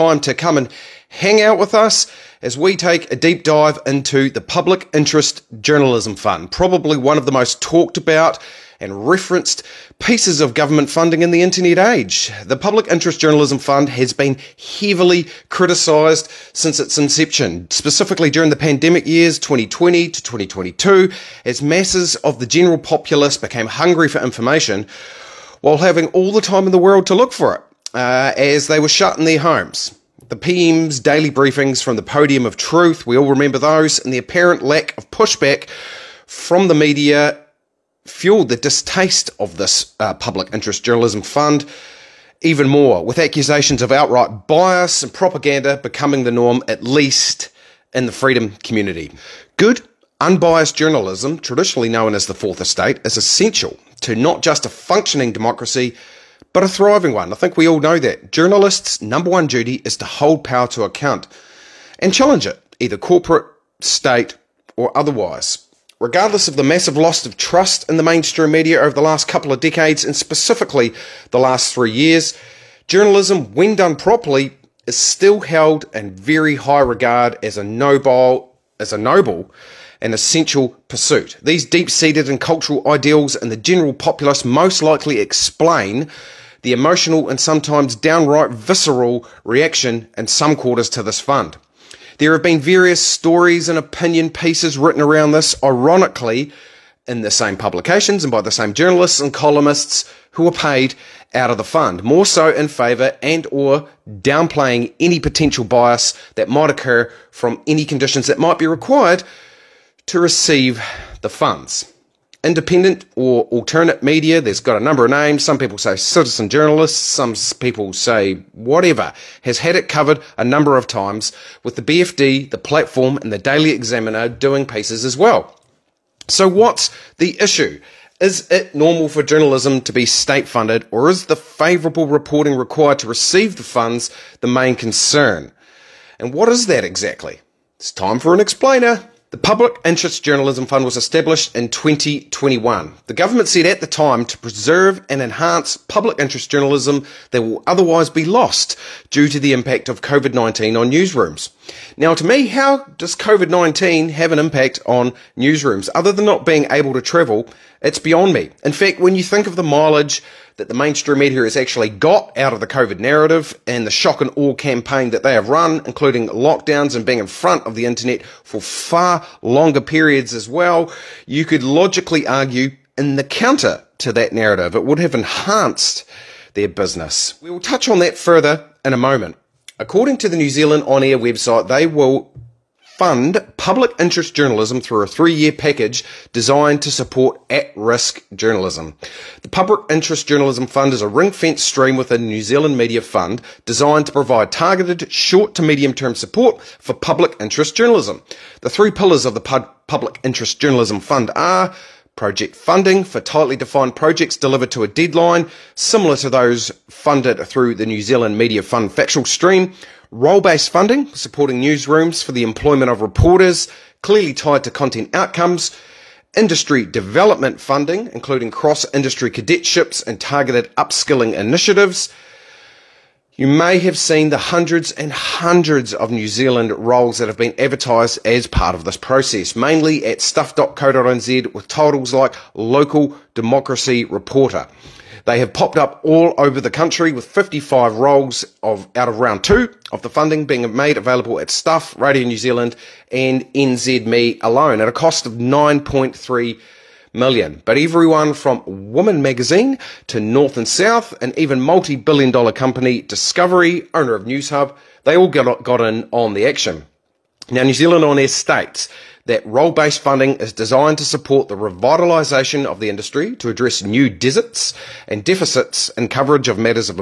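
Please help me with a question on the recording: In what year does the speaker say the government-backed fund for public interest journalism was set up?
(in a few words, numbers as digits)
2021.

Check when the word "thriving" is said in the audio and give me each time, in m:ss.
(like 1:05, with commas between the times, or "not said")
0:56.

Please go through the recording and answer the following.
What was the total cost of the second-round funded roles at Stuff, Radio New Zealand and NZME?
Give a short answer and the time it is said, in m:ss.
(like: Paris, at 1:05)
9.3 million, at 4:05.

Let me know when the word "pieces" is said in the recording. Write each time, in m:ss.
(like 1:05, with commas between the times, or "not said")
0:09, 1:34, 2:04.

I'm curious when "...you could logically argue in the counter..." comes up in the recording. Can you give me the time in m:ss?
2:51.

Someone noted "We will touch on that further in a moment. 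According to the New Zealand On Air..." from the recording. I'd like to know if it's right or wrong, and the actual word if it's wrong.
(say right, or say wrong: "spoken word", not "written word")
right.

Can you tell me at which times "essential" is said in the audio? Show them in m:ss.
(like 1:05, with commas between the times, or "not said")
0:53, 1:20.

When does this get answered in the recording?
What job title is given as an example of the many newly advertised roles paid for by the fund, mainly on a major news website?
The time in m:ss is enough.
3:52.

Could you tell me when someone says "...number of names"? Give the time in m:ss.
1:54.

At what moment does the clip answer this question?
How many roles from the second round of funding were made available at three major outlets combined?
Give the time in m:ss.
3:57.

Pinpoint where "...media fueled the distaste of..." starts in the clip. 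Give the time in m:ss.
0:36.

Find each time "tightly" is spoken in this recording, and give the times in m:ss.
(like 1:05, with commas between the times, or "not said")
3:23.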